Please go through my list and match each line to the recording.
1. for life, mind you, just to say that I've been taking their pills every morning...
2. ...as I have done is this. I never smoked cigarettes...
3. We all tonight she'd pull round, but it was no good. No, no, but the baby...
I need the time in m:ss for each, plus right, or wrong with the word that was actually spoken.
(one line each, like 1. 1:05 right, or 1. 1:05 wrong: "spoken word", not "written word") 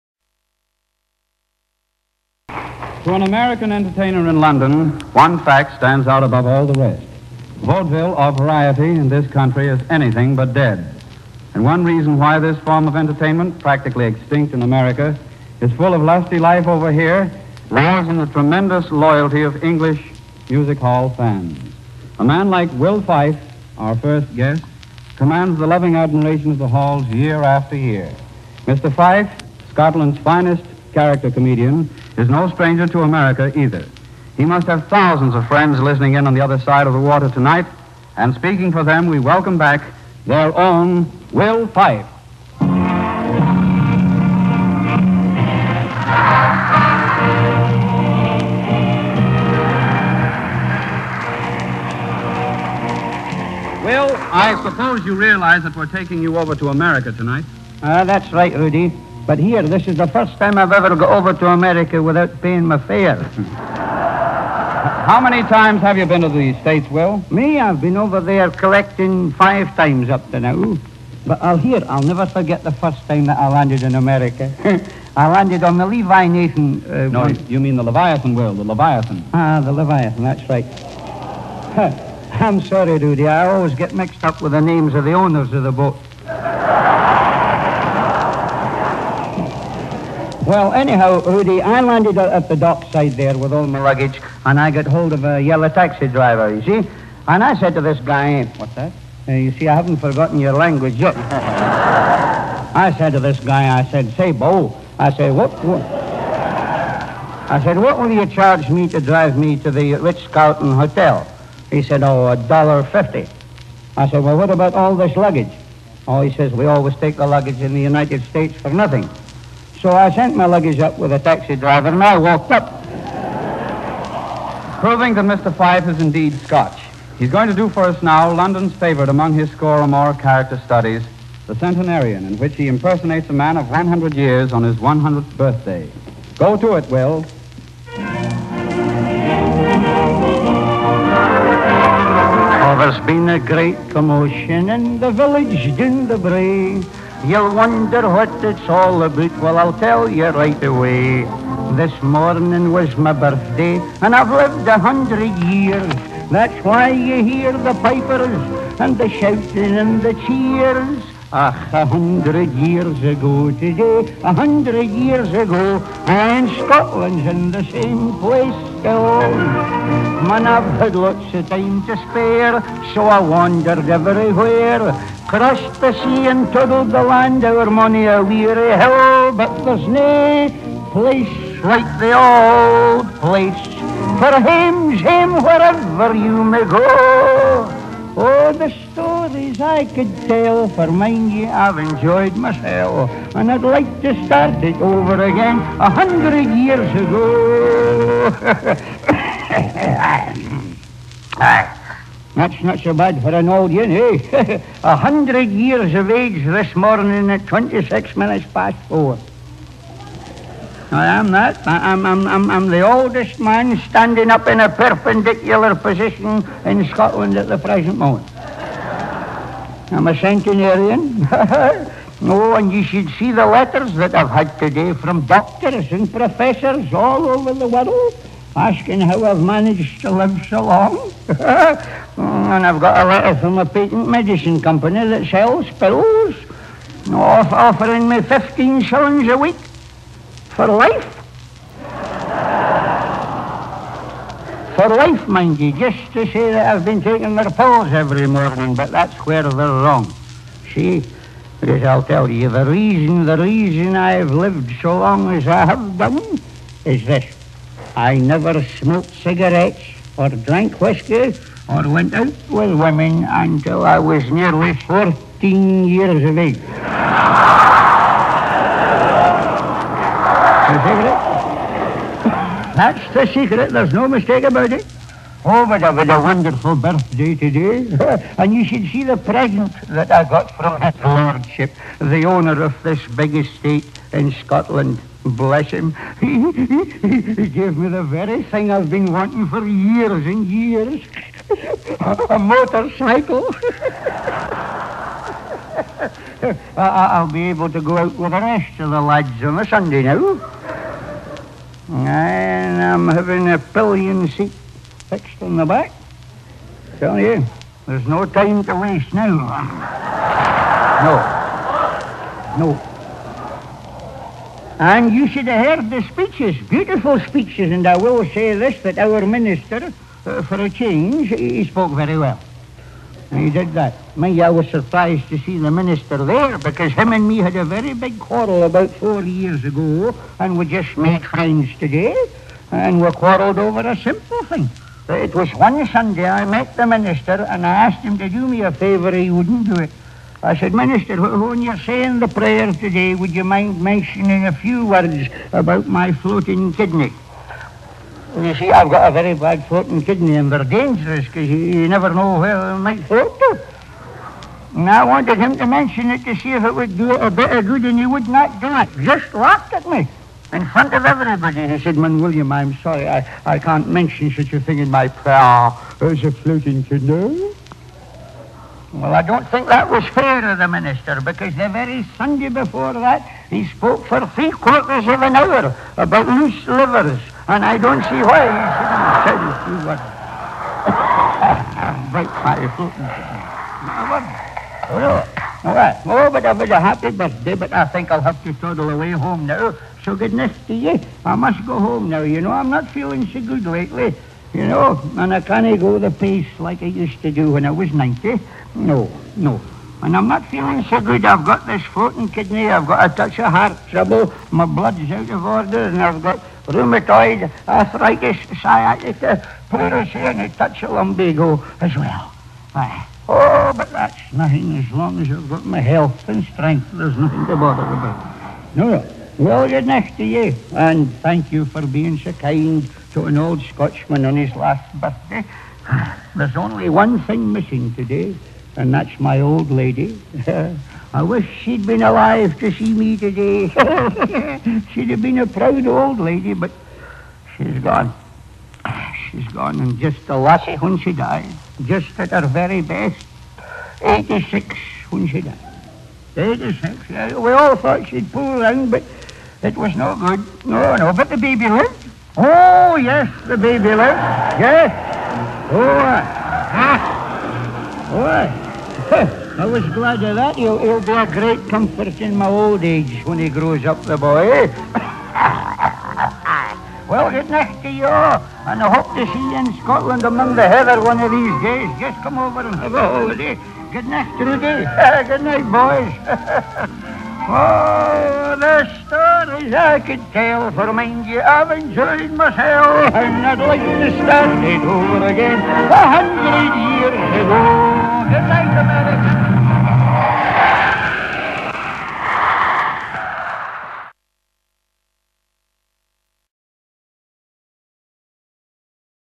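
1. 4:04 right
2. 4:15 right
3. 7:27 wrong: "thought", not "tonight".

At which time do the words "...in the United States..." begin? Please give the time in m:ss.
1:57.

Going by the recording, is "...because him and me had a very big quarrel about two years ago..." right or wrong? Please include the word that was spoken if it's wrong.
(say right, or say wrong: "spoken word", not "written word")
wrong: "four", not "two".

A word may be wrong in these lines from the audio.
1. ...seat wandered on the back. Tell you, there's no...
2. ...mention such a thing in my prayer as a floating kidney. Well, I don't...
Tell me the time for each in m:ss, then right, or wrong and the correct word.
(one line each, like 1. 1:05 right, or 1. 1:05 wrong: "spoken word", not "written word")
1. 5:04 wrong: "fixed", not "wandered"
2. 6:03 right.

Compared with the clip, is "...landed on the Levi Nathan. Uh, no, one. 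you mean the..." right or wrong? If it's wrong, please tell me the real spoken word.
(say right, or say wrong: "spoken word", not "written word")
right.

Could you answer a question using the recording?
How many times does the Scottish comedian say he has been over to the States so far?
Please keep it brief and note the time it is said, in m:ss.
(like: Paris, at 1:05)
5, at 1:09.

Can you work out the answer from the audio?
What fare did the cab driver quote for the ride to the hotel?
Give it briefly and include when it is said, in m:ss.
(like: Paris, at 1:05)
$1.50, at 1:52.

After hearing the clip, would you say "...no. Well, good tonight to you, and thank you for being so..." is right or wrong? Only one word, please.
wrong.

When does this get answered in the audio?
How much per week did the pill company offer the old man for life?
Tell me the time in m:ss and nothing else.
3:58.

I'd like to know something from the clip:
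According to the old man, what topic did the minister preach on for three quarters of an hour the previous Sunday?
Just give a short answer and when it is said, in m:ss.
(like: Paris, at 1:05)
Loose livers, at 6:16.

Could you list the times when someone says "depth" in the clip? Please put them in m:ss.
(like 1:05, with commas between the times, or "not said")
not said.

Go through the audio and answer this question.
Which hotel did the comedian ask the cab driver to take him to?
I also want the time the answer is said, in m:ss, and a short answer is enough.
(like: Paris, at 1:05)
Ritz Carlton Hotel, at 1:49.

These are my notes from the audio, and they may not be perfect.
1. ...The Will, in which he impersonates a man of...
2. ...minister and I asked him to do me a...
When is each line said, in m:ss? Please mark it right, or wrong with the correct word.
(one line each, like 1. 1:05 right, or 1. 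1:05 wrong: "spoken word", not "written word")
1. 2:11 wrong: "Centenarian", not "Will"
2. 5:36 right.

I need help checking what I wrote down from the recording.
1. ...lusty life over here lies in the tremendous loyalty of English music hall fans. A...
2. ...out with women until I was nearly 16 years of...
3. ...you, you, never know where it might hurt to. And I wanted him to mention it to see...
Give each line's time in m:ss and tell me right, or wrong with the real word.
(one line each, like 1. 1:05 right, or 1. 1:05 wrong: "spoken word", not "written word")
1. 0:16 right
2. 4:22 wrong: "14", not "16"
3. 5:51 right.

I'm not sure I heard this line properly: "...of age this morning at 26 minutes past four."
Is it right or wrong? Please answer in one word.
right.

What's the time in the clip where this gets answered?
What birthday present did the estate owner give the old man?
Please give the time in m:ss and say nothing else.
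4:52.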